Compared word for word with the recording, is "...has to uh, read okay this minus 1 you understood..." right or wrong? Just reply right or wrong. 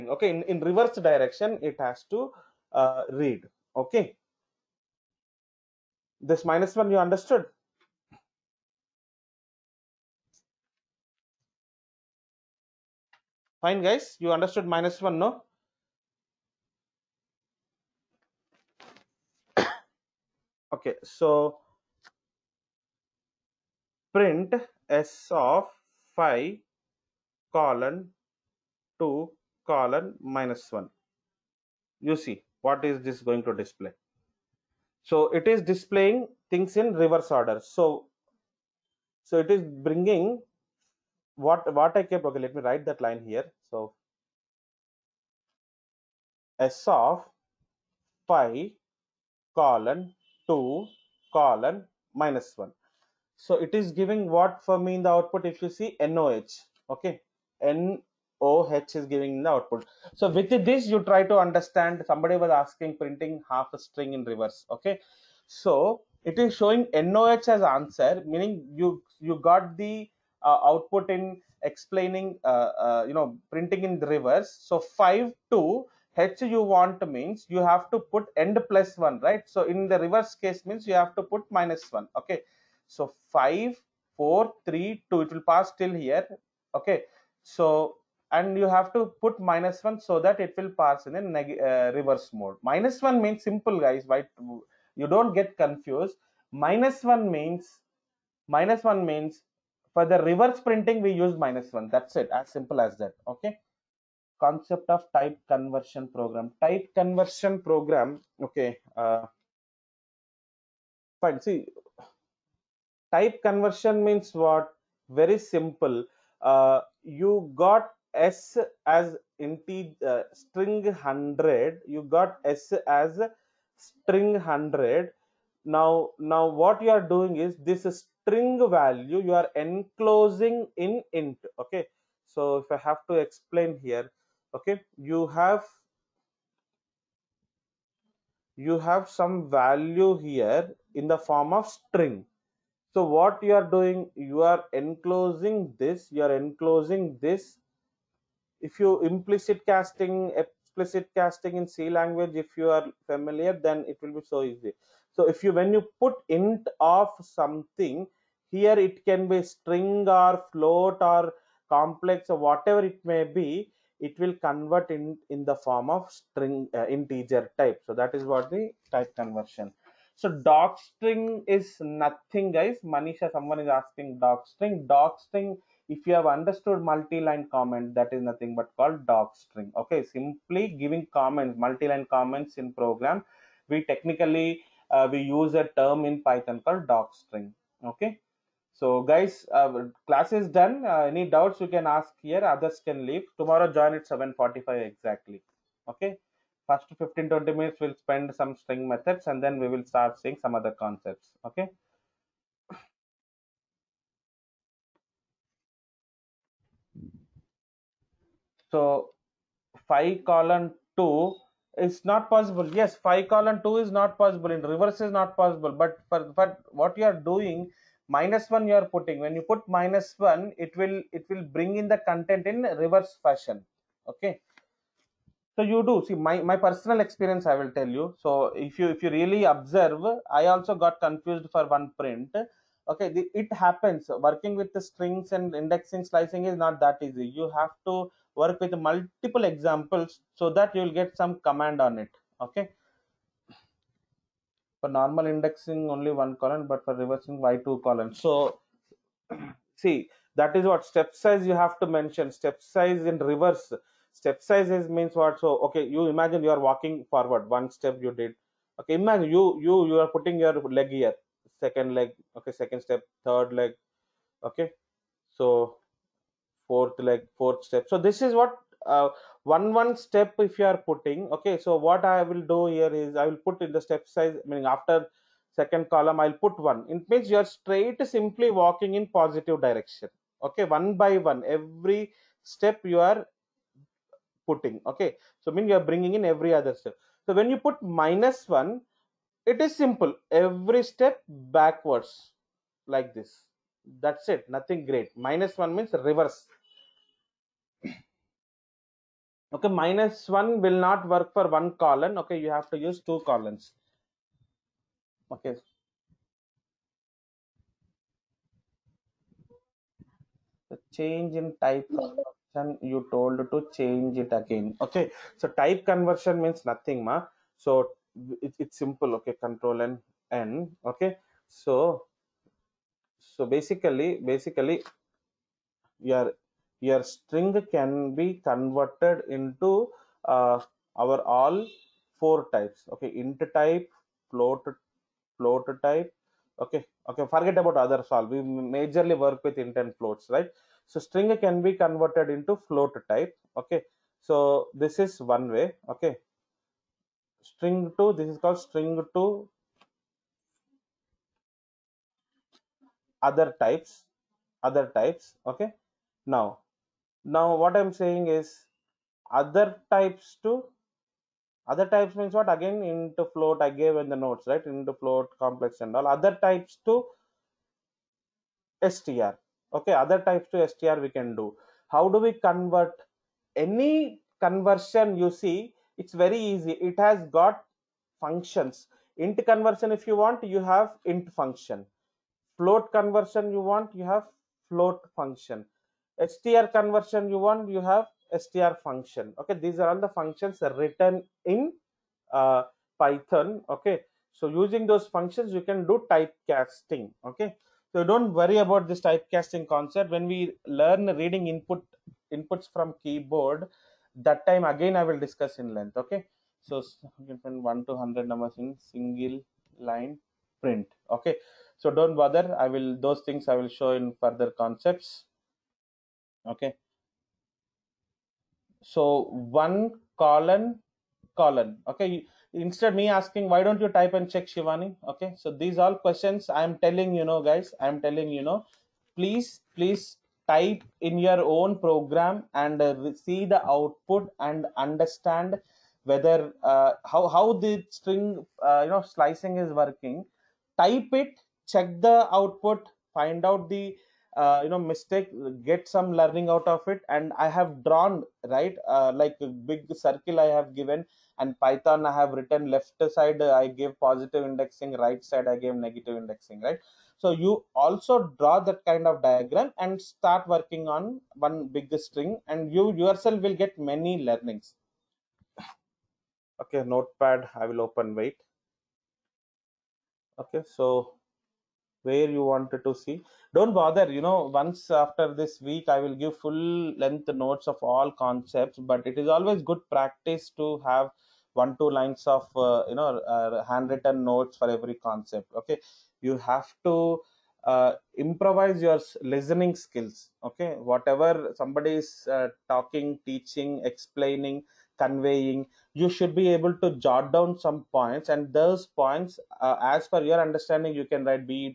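right.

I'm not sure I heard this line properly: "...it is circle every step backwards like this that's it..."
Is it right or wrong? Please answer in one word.
wrong.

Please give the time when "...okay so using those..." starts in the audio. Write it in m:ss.
6:33.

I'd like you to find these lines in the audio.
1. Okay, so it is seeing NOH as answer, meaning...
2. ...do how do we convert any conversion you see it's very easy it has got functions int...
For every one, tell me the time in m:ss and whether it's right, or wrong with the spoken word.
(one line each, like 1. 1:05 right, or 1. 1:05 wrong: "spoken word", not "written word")
1. 1:04 wrong: "showing", not "seeing"
2. 6:11 right.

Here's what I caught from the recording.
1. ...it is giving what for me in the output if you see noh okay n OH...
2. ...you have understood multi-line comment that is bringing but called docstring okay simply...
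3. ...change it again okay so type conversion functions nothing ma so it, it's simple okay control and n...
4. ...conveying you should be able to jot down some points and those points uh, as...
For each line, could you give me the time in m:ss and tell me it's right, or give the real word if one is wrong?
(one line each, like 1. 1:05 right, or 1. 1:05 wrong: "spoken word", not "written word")
1. 0:53 right
2. 2:56 wrong: "nothing", not "bringing"
3. 5:13 wrong: "means", not "functions"
4. 8:14 right.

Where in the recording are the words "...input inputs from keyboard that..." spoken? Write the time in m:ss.
6:41.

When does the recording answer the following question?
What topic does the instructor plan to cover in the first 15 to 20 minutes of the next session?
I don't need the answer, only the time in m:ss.
3:18.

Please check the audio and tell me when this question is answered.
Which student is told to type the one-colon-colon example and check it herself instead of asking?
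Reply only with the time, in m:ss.
7:04.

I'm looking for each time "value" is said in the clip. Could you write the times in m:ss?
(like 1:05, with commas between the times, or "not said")
2:08, 2:19.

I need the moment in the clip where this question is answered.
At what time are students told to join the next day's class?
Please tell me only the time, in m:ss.
3:14.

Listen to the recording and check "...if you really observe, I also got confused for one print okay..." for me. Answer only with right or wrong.
right.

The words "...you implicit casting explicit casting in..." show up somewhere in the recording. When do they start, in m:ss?
2:28.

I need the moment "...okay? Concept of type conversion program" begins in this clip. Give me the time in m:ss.
1:43.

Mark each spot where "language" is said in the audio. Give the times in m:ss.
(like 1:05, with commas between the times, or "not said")
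2:31.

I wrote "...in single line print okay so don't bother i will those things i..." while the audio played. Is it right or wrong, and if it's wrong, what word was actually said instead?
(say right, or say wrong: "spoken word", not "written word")
right.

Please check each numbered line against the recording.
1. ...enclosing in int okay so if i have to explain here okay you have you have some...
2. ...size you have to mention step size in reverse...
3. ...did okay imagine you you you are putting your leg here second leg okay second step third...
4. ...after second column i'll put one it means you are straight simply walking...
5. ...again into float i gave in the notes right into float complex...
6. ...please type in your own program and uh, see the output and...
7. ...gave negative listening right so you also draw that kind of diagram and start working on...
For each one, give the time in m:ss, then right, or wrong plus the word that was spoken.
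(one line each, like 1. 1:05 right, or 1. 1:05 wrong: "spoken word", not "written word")
1. 2:09 right
2. 4:11 right
3. 4:18 right
4. 4:34 right
5. 6:02 right
6. 7:09 right
7. 7:35 wrong: "indexing", not "listening".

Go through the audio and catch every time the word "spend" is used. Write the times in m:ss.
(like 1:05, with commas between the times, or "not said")
3:17.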